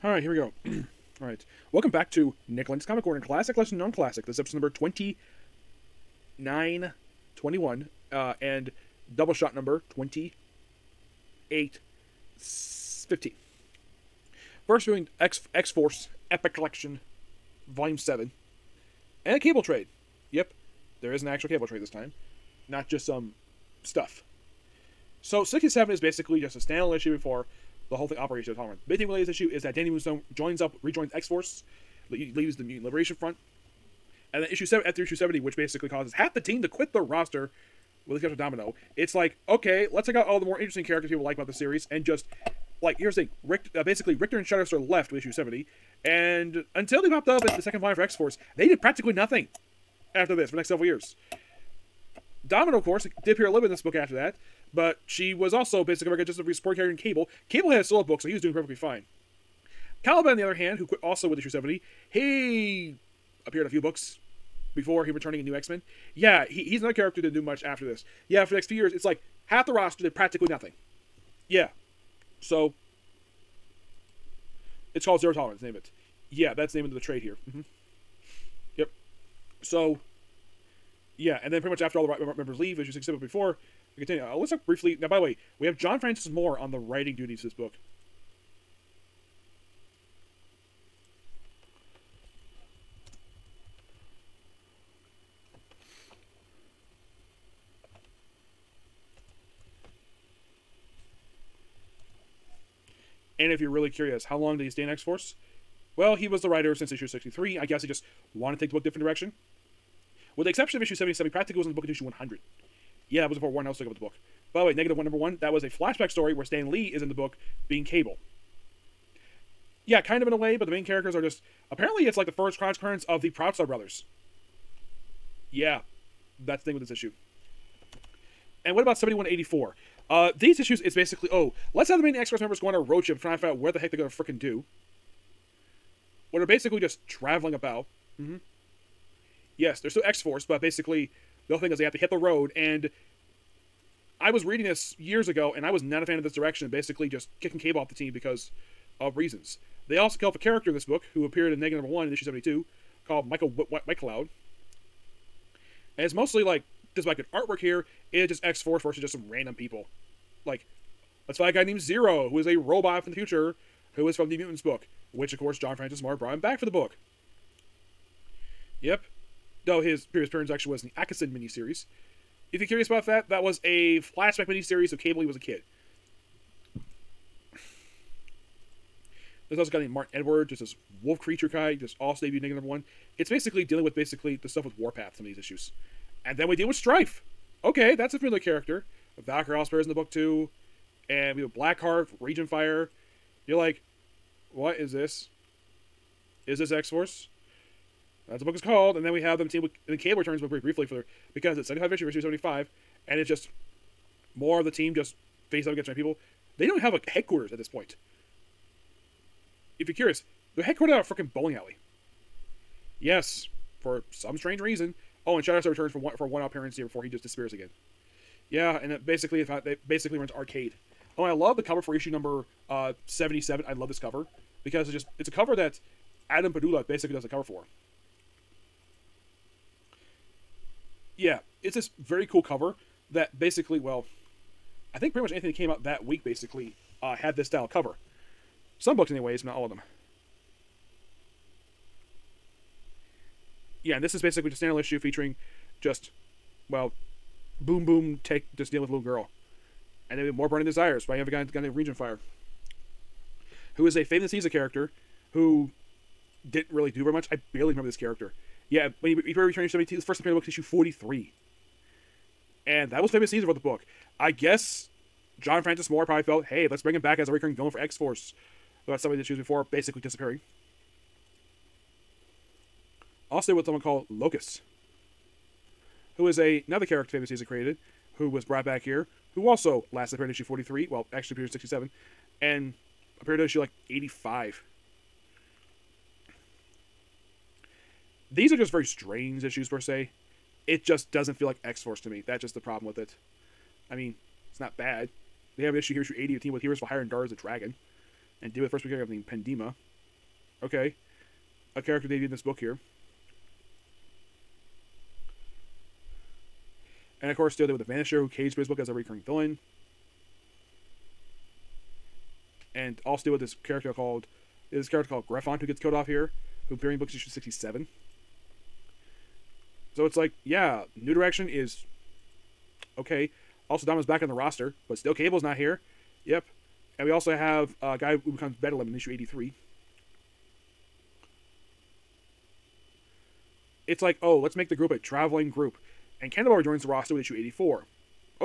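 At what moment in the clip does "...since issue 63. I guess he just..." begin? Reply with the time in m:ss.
1:46.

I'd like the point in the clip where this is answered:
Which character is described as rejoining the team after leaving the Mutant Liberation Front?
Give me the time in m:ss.
0:29.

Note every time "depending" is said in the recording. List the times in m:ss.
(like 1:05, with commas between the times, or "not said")
not said.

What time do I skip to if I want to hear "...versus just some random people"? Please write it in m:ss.
2:38.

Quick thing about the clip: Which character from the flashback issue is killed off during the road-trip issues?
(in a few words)
Michael Whitecloud.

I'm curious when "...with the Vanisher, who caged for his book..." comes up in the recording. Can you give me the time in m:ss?
5:07.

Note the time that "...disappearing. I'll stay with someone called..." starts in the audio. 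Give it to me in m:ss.
4:29.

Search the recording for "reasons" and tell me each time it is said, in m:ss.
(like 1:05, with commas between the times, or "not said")
2:29, 3:34.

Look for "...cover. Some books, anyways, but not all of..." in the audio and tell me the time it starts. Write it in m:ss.
3:57.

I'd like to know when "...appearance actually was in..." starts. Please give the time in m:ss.
2:50.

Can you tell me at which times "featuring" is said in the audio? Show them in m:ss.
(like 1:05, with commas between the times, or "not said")
4:04.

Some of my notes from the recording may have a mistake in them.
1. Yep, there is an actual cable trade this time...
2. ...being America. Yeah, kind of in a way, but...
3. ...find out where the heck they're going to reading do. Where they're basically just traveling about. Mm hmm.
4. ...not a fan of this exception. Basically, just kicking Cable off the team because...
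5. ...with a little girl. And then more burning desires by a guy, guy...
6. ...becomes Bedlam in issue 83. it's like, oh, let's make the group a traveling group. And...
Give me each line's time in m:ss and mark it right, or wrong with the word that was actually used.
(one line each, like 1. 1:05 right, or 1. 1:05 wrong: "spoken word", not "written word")
1. 0:20 right
2. 1:57 wrong: "Cable", not "America"
3. 2:13 wrong: "freaking", not "reading"
4. 2:25 wrong: "direction", not "exception"
5. 4:08 right
6. 5:28 right.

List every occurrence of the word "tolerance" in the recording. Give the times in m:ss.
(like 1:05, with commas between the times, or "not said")
0:28, 1:15.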